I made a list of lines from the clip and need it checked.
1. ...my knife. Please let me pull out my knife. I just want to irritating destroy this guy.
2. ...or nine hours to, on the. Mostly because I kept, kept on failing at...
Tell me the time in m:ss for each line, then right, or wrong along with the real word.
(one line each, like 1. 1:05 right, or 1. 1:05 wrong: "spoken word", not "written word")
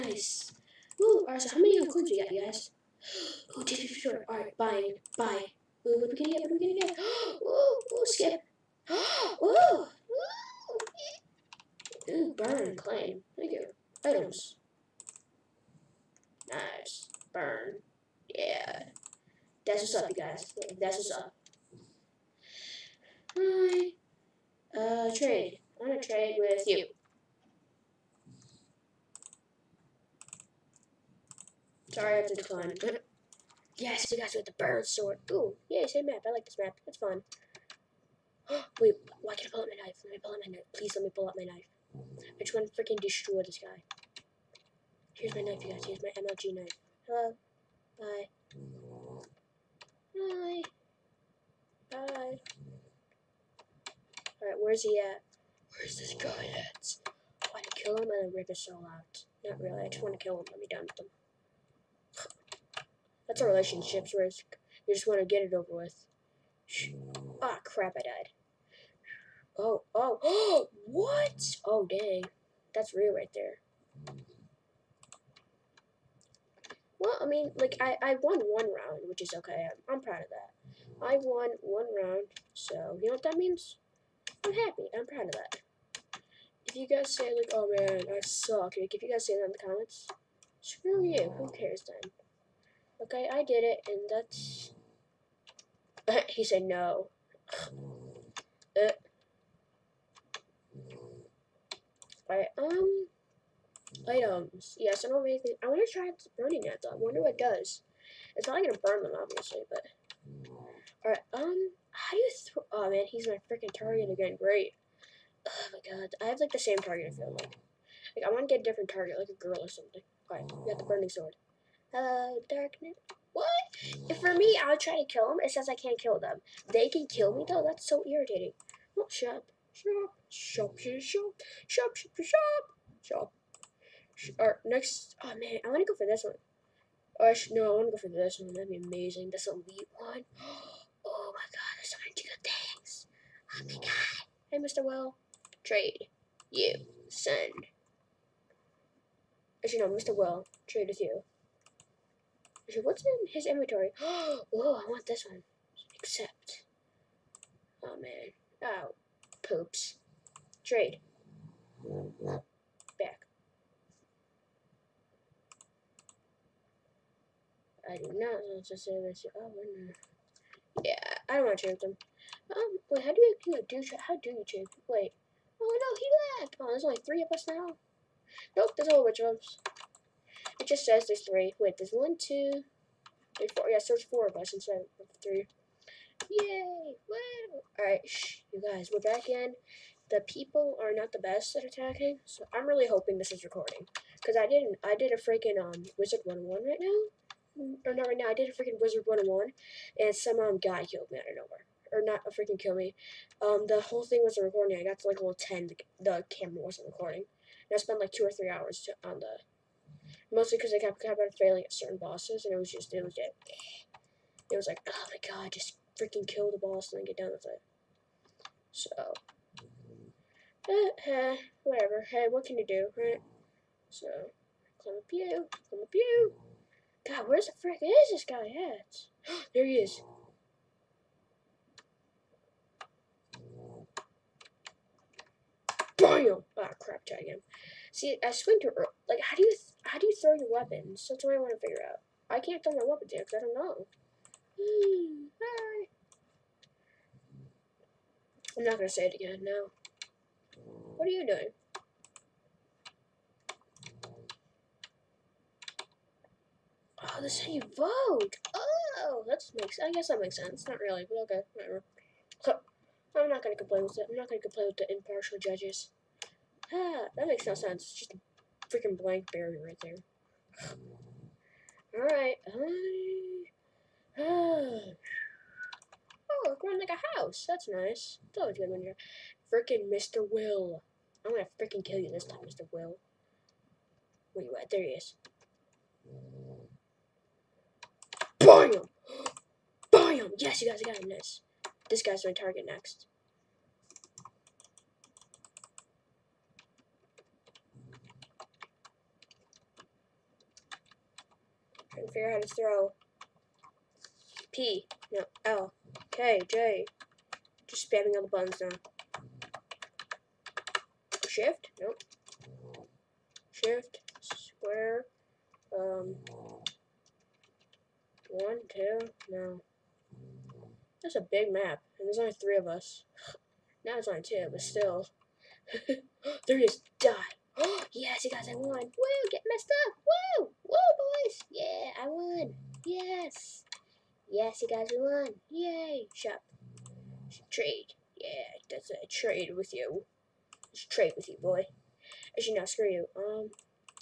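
1. 0:40 wrong: "freaking", not "irritating"
2. 3:28 wrong: "three", not "nine".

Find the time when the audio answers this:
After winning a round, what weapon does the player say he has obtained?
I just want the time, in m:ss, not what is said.
2:00.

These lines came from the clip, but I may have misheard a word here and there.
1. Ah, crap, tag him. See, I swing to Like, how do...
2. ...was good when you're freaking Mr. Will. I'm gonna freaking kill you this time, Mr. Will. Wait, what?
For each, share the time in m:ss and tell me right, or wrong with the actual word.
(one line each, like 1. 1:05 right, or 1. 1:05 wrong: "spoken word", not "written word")
1. 3:56 right
2. 4:38 right.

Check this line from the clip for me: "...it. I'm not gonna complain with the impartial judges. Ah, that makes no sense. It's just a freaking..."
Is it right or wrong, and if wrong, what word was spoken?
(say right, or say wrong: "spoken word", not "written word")
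right.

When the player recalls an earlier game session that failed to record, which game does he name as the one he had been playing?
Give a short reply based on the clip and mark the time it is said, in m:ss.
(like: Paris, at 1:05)
Wizard 101, at 3:18.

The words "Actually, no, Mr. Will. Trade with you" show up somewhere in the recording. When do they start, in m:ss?
2:29.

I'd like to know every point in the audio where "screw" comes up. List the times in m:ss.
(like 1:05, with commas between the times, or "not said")
1:30, 5:42.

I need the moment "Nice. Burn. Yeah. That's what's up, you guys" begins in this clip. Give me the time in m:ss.
0:16.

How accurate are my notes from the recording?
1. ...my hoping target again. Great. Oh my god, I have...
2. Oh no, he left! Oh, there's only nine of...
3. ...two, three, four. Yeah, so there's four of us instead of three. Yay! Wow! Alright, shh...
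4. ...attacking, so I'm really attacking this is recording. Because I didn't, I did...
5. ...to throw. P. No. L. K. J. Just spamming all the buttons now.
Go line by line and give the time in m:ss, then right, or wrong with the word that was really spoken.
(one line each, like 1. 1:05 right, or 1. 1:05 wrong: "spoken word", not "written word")
1. 1:53 wrong: "freaking", not "hoping"
2. 2:55 wrong: "three", not "nine"
3. 3:02 right
4. 3:11 wrong: "hoping", not "attacking"
5. 5:02 right.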